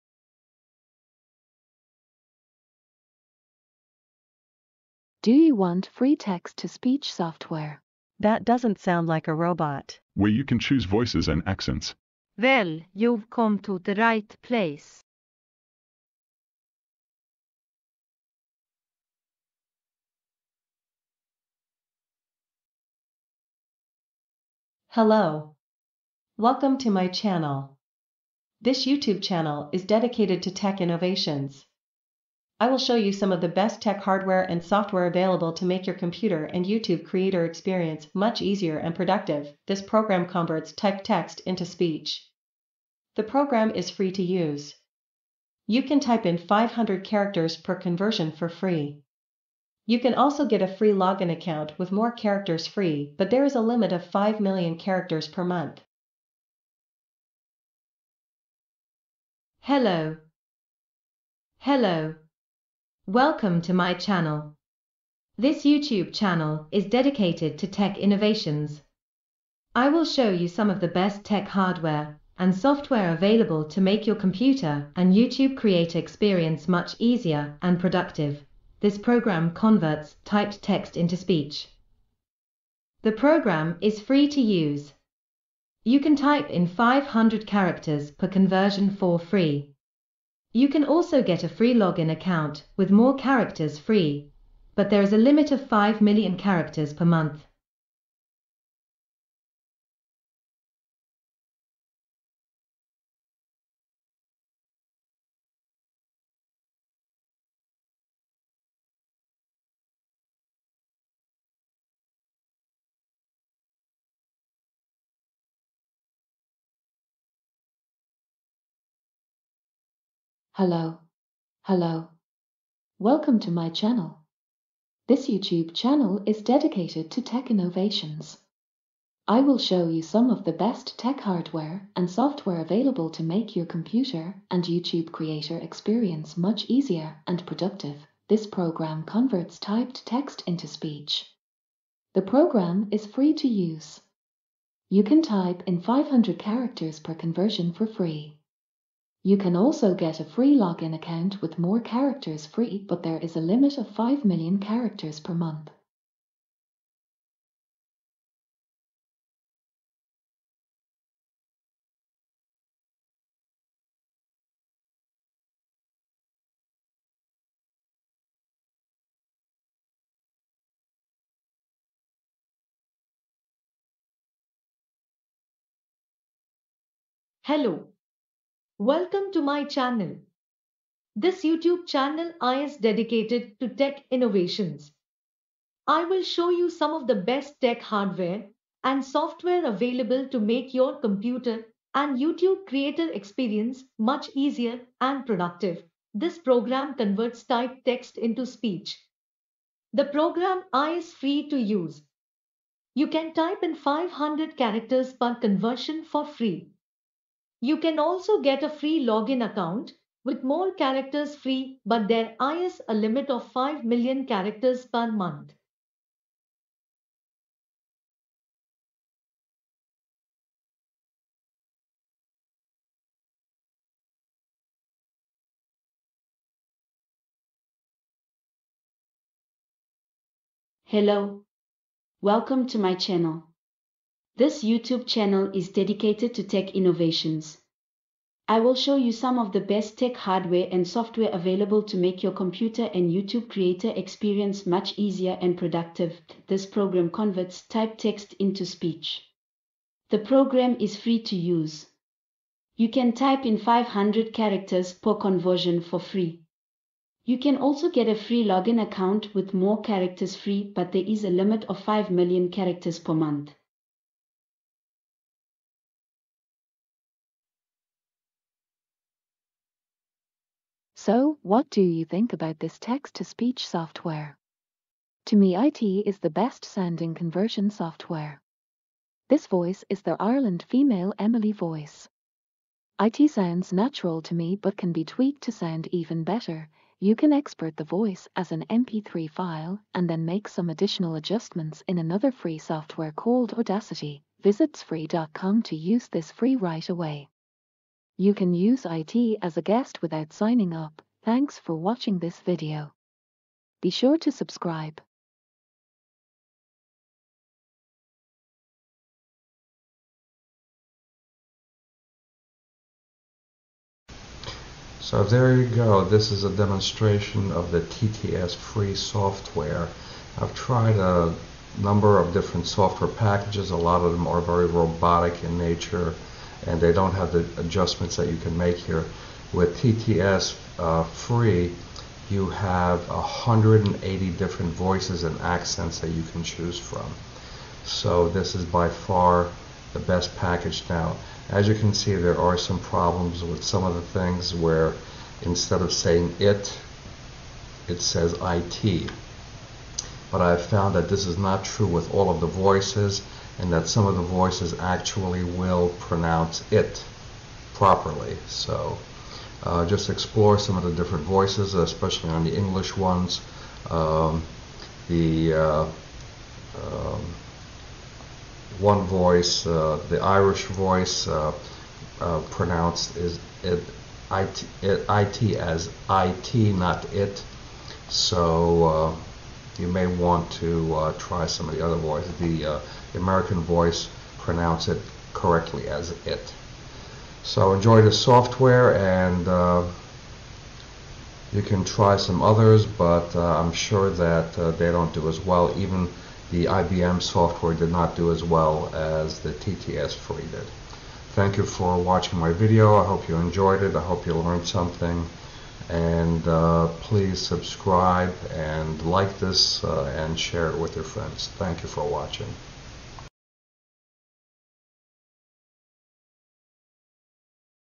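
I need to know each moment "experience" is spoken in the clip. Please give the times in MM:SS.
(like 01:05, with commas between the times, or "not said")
00:37, 01:15, 02:15, 03:13, 04:03.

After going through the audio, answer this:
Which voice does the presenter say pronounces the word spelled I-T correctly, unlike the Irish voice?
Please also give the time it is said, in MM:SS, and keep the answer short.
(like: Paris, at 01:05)
American voice, at 06:23.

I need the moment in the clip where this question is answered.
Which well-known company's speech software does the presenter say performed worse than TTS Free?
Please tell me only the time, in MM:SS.
06:36.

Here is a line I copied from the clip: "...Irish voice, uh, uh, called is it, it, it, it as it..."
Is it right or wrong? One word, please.
wrong.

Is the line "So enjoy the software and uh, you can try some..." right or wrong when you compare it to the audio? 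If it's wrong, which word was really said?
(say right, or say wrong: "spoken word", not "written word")
right.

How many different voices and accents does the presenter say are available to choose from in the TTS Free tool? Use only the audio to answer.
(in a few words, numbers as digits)
180.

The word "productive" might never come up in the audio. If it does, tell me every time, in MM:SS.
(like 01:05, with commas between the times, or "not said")
00:38, 01:17, 02:17, 03:15, 04:05.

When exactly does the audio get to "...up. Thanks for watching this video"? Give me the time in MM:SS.
05:00.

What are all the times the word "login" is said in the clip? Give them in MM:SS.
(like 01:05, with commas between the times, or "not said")
00:50, 01:31, 02:30, 03:29, 04:18.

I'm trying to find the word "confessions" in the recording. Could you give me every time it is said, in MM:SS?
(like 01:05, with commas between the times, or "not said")
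not said.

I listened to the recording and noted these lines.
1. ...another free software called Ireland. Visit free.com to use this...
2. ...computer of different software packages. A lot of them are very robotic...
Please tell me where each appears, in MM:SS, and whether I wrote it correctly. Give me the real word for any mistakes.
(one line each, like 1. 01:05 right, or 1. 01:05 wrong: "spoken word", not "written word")
1. 04:51 wrong: "Audacity", not "Ireland"
2. 05:21 wrong: "number", not "computer".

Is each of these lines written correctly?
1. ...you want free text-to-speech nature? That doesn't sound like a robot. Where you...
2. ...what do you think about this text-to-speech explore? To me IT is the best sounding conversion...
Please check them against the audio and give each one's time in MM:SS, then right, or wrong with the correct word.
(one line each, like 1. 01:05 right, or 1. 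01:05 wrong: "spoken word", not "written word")
1. 00:05 wrong: "software", not "nature"
2. 04:31 wrong: "software", not "explore".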